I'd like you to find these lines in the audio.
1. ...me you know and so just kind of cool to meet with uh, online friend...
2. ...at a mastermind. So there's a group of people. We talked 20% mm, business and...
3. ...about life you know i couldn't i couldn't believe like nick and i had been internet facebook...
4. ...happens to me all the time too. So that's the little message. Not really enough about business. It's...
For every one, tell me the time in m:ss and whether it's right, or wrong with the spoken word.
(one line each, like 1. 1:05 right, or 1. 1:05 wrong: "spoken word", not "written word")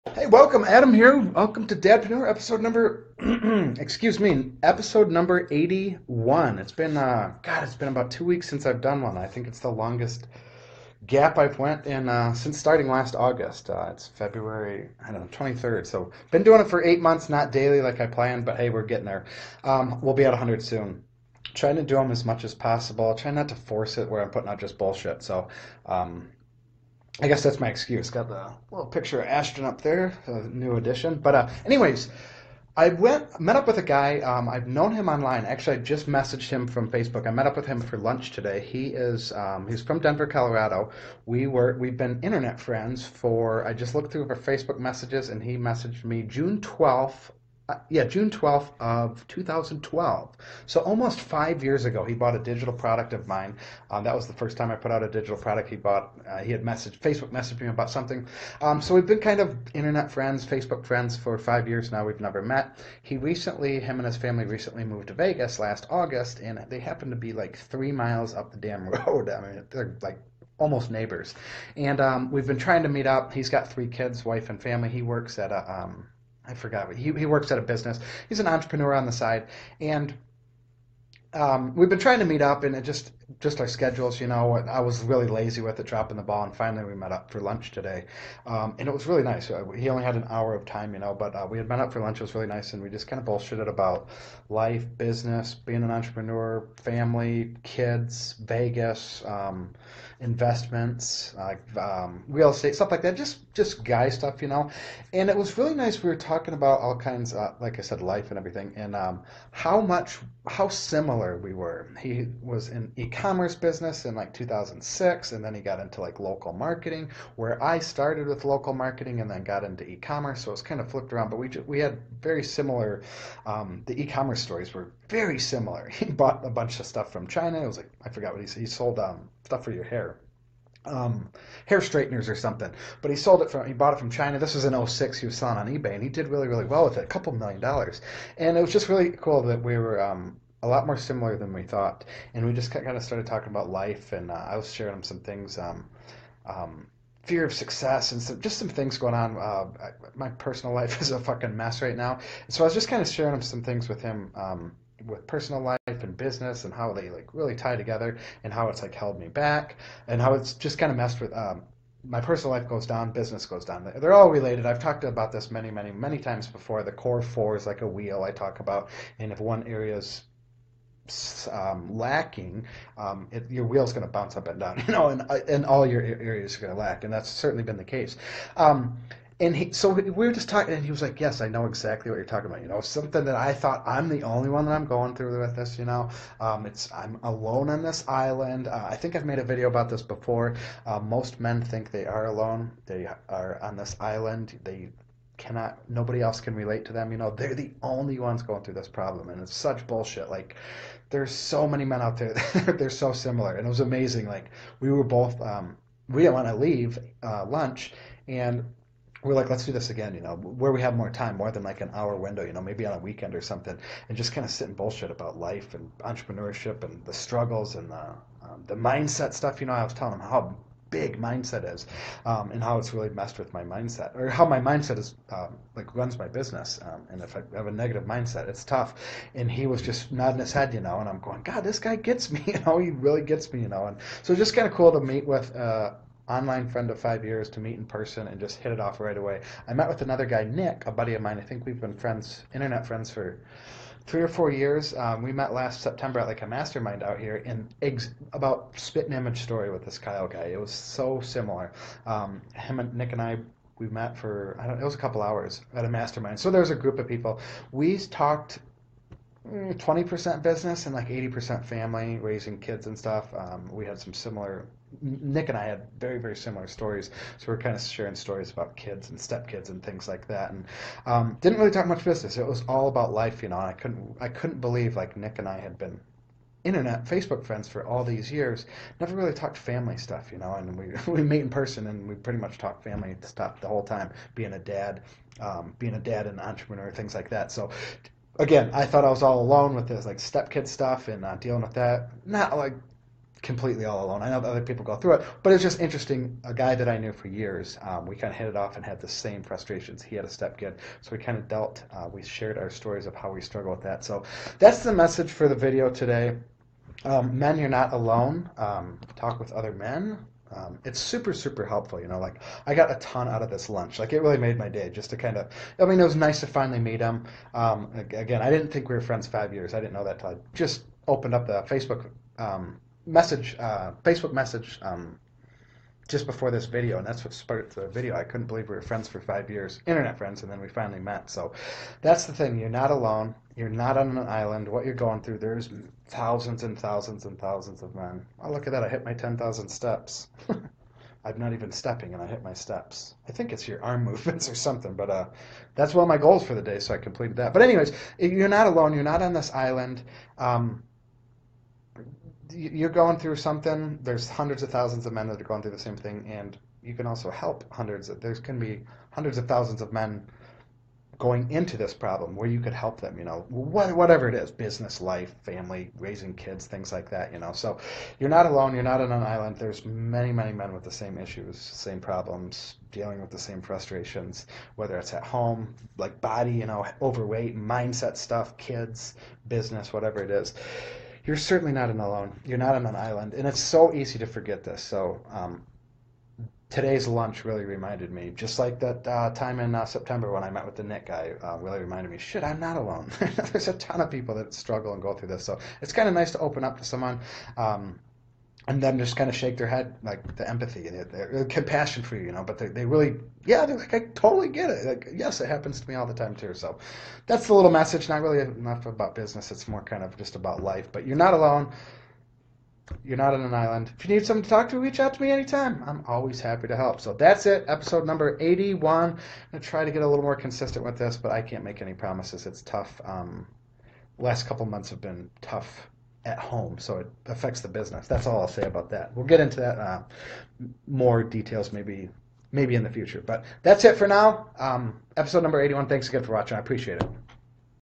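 1. 3:53 right
2. 4:15 right
3. 4:32 right
4. 6:45 right.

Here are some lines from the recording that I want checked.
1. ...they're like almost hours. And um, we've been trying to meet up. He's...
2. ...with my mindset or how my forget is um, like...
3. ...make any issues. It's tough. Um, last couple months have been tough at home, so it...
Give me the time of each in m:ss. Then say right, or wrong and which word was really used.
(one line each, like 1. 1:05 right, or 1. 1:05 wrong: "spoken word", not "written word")
1. 1:09 wrong: "neighbors", not "hours"
2. 3:43 wrong: "mindset", not "forget"
3. 7:01 wrong: "promises", not "issues".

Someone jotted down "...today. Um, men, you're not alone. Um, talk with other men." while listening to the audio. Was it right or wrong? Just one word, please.
right.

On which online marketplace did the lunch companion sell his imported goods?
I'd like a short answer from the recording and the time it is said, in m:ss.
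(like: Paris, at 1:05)
eBay, at 2:15.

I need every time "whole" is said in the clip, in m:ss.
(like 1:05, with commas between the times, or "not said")
4:43.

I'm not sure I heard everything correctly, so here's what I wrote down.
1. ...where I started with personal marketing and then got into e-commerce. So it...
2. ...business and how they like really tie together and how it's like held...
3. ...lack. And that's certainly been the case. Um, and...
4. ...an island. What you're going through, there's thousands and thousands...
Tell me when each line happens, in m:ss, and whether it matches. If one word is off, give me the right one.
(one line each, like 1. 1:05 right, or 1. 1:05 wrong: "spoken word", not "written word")
1. 1:57 wrong: "local", not "personal"
2. 2:36 right
3. 2:56 right
4. 5:34 right.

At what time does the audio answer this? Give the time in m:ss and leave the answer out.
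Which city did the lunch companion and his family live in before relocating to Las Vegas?
0:39.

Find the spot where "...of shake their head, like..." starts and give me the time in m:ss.
6:39.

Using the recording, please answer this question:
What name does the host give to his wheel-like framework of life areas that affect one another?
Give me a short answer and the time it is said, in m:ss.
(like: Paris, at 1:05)
The core four, at 2:46.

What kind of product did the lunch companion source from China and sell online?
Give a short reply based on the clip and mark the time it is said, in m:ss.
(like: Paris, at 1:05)
hair straighteners, at 2:11.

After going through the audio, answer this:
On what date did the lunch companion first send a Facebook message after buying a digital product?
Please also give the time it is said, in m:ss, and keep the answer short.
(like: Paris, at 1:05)
June 12, 2012, at 0:48.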